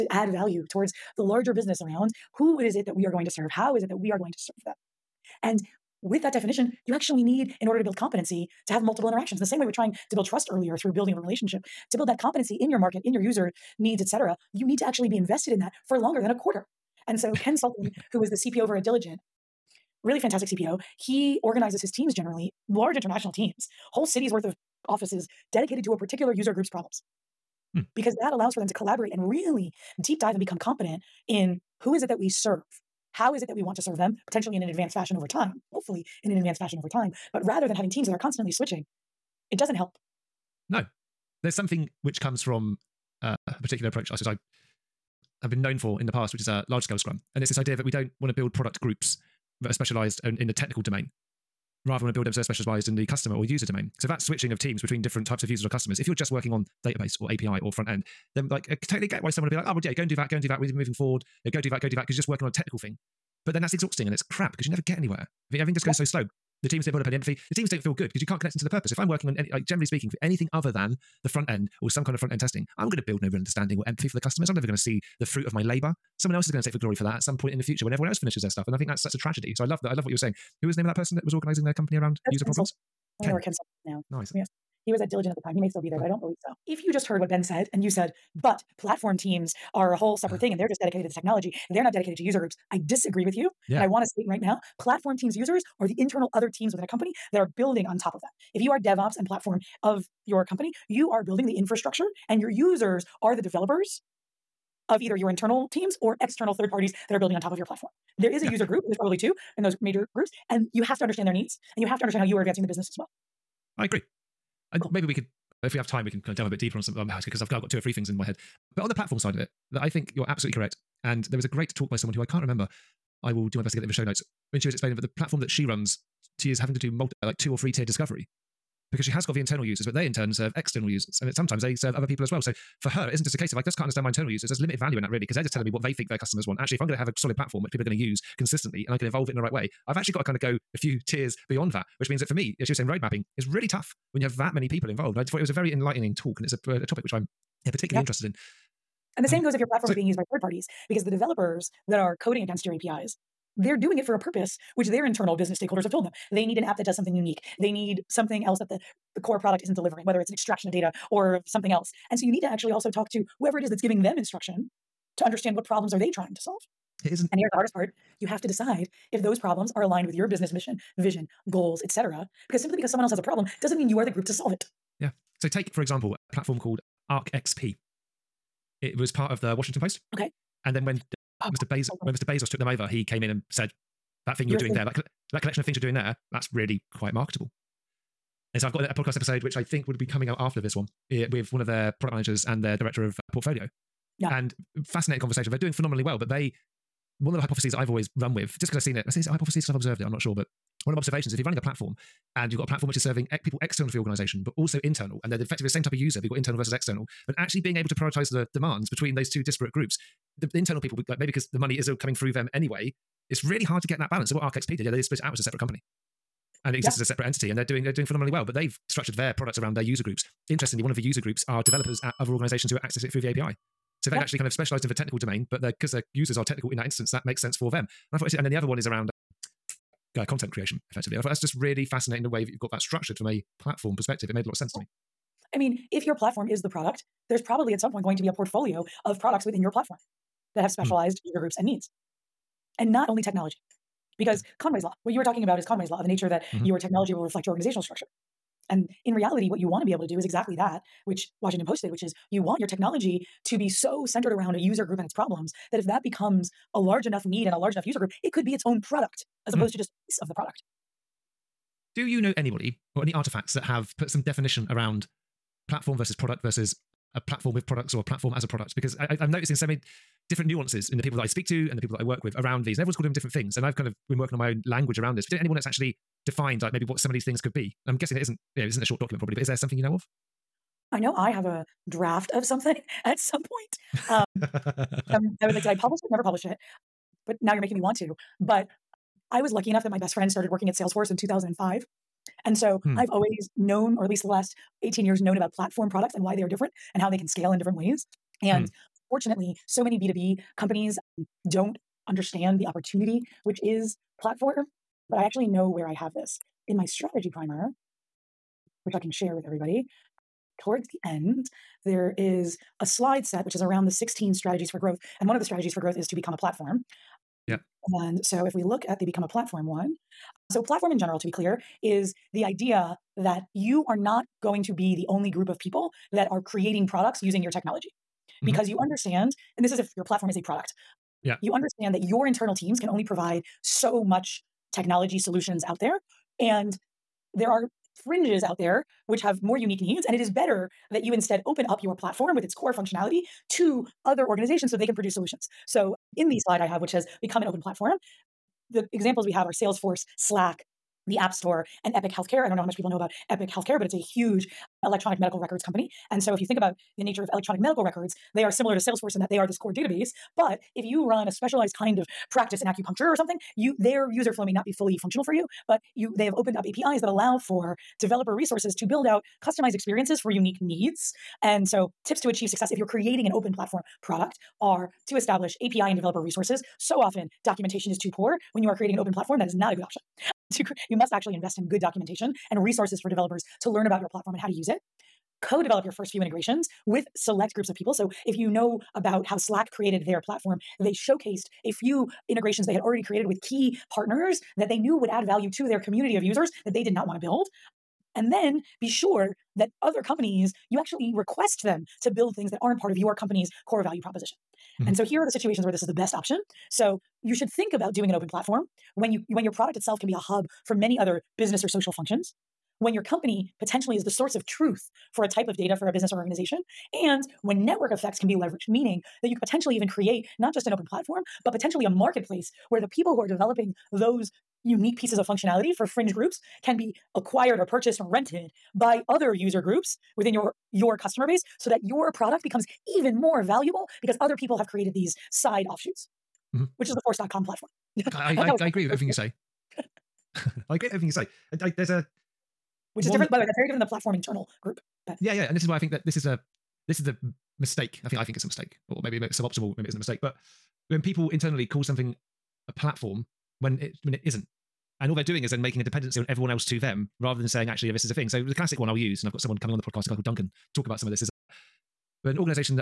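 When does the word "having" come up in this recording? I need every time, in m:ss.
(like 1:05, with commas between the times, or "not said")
0:37, 2:06.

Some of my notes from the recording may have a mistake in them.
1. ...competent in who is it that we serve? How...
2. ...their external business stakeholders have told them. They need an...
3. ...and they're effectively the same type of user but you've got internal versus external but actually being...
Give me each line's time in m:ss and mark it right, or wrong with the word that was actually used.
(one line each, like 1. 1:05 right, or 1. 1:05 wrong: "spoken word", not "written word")
1. 0:30 right
2. 2:34 wrong: "internal", not "external"
3. 3:25 right.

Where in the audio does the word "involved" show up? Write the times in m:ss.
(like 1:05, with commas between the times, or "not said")
2:24.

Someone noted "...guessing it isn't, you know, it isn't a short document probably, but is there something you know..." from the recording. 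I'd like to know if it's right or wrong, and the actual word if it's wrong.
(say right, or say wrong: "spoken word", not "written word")
right.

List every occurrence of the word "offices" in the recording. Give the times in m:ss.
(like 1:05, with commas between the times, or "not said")
0:24.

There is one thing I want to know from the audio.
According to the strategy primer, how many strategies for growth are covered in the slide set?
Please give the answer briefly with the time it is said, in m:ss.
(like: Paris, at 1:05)
16, at 5:13.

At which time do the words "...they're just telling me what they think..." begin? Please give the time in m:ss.
2:15.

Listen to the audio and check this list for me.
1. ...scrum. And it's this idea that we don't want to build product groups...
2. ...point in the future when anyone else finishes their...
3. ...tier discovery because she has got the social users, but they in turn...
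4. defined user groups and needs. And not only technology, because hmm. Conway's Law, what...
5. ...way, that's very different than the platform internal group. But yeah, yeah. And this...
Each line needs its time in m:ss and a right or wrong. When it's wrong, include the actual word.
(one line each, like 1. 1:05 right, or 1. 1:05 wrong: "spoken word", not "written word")
1. 0:46 right
2. 1:17 wrong: "everyone", not "anyone"
3. 2:07 wrong: "internal", not "social"
4. 4:00 wrong: "specialized", not "defined"
5. 7:23 right.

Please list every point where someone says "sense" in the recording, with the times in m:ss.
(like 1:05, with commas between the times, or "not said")
3:47, 3:54.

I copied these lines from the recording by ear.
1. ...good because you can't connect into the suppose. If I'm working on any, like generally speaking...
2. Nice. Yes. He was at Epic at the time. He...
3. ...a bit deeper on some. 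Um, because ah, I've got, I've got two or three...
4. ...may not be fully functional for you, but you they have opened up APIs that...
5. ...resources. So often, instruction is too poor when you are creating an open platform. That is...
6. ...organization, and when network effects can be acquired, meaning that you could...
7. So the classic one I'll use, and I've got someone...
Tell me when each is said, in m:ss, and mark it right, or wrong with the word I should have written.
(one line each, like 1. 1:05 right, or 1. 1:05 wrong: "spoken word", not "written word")
1. 1:07 wrong: "purpose", not "suppose"
2. 1:24 wrong: "Diligent", not "Epic"
3. 1:56 right
4. 6:04 right
5. 6:16 wrong: "documentation", not "instruction"
6. 6:56 wrong: "leveraged", not "acquired"
7. 7:38 right.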